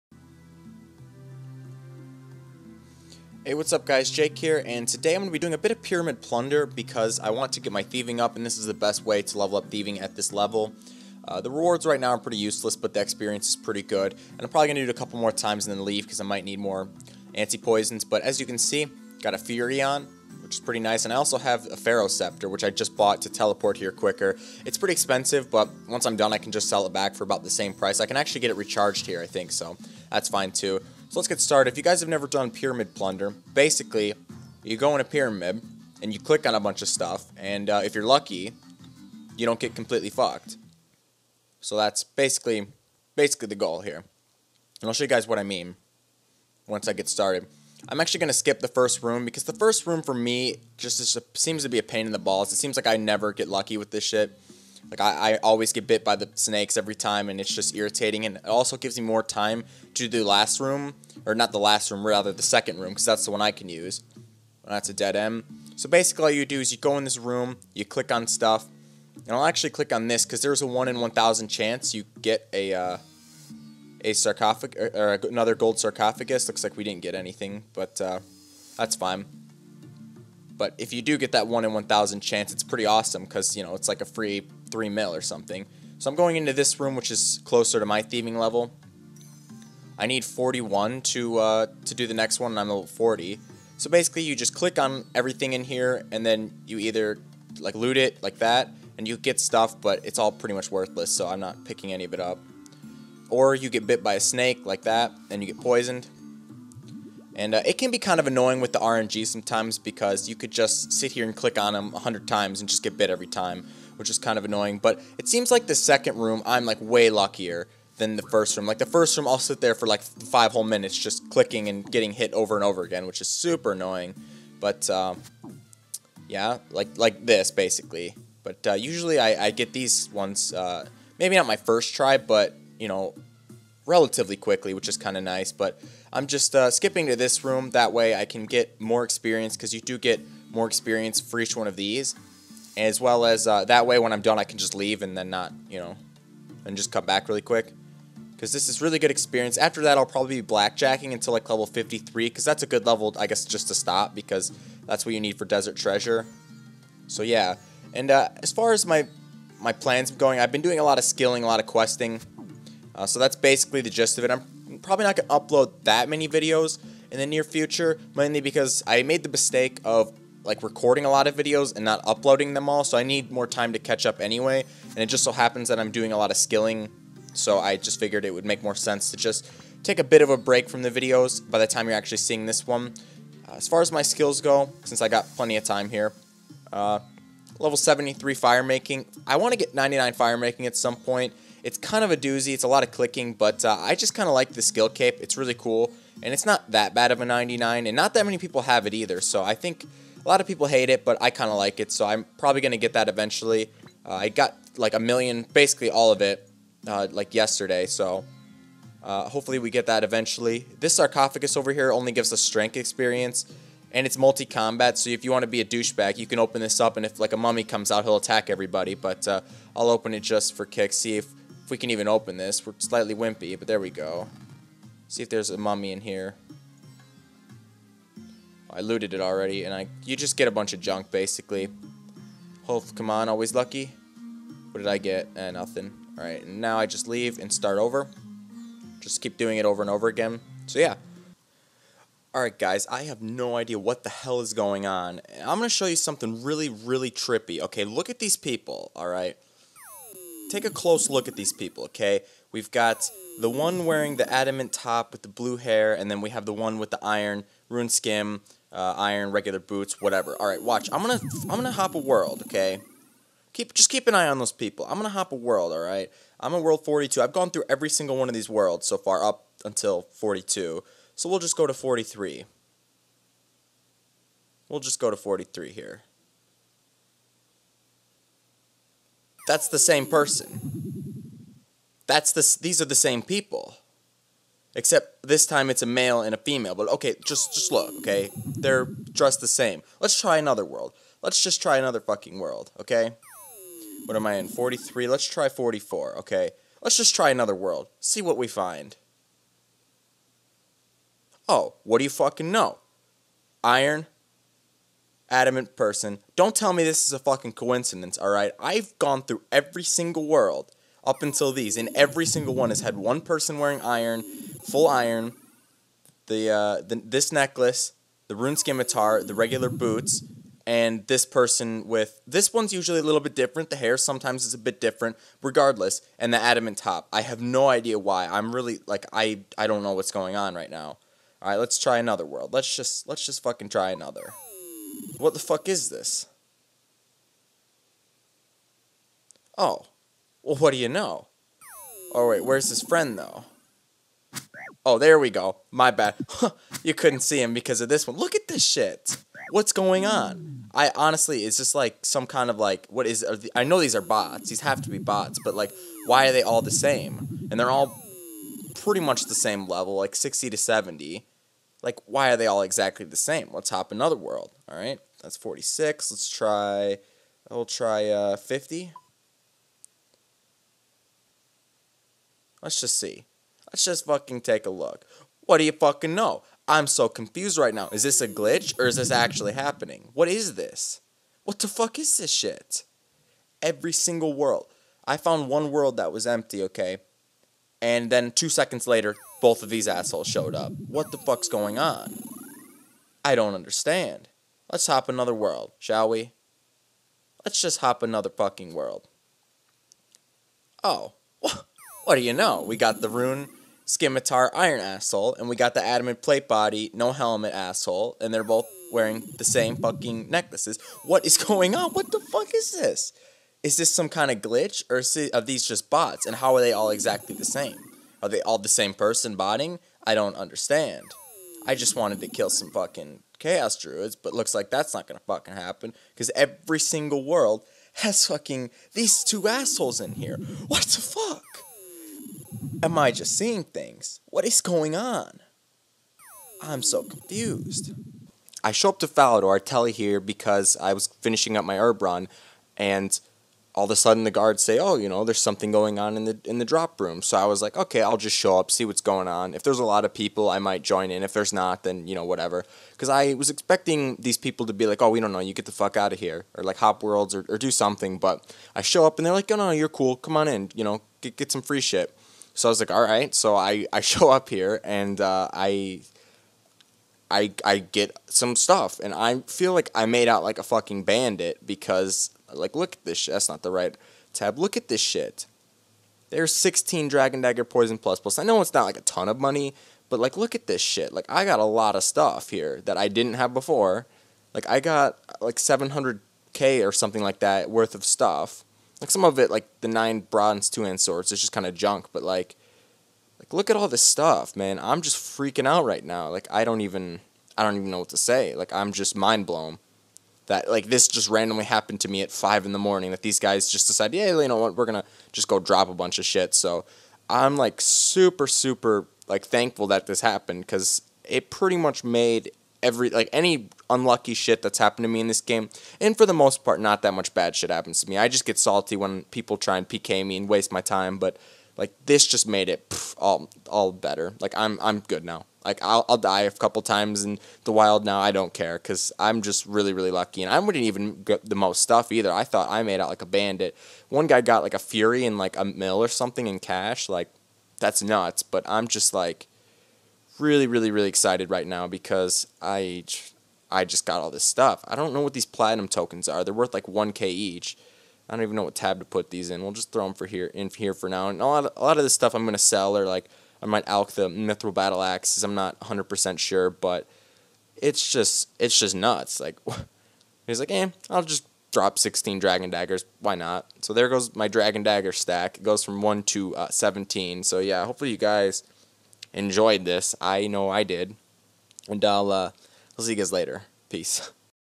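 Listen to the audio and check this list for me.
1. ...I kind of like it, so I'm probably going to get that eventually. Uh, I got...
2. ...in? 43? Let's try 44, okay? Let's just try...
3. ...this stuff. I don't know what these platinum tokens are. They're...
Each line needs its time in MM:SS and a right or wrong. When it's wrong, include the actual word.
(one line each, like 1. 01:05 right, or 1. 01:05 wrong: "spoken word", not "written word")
1. 03:21 right
2. 04:54 right
3. 09:04 right.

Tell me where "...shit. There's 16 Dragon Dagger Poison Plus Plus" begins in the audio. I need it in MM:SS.
07:55.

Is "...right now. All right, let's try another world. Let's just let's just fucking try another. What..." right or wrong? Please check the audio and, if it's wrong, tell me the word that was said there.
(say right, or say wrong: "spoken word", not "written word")
right.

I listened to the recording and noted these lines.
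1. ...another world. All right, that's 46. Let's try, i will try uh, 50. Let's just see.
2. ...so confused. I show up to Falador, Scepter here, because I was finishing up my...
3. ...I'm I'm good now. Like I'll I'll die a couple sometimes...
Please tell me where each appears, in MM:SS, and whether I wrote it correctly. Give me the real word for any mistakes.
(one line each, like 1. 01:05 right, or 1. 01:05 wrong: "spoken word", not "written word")
1. 06:03 right
2. 07:16 wrong: "Telly", not "Scepter"
3. 08:44 wrong: "times", not "sometimes".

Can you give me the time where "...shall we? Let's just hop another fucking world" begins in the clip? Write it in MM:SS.
06:35.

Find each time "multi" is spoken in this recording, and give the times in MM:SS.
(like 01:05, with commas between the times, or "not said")
03:34.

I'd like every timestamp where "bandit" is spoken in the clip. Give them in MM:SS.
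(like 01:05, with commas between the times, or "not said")
07:51, 08:53.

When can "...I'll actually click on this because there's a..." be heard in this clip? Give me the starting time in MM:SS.
01:09.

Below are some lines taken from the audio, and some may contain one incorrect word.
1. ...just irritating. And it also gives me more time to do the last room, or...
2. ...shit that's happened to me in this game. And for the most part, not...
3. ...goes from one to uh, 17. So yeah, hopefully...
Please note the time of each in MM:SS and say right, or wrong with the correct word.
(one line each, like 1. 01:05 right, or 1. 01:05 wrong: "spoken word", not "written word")
1. 00:57 right
2. 08:34 right
3. 09:25 right.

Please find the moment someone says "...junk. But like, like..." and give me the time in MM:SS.
08:11.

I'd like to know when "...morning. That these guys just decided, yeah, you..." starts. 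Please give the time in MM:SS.
08:22.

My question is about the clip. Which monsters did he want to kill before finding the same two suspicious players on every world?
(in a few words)
chaos druids.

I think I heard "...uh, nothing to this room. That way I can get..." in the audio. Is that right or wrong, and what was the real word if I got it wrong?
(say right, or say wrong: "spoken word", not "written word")
wrong: "skipping", not "nothing".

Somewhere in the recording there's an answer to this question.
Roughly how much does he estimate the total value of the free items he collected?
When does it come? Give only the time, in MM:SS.
08:05.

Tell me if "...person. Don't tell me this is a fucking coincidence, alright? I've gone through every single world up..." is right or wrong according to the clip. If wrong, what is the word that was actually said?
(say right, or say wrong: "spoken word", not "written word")
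right.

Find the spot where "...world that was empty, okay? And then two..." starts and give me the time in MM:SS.
06:25.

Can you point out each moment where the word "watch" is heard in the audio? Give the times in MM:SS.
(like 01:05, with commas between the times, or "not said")
04:20.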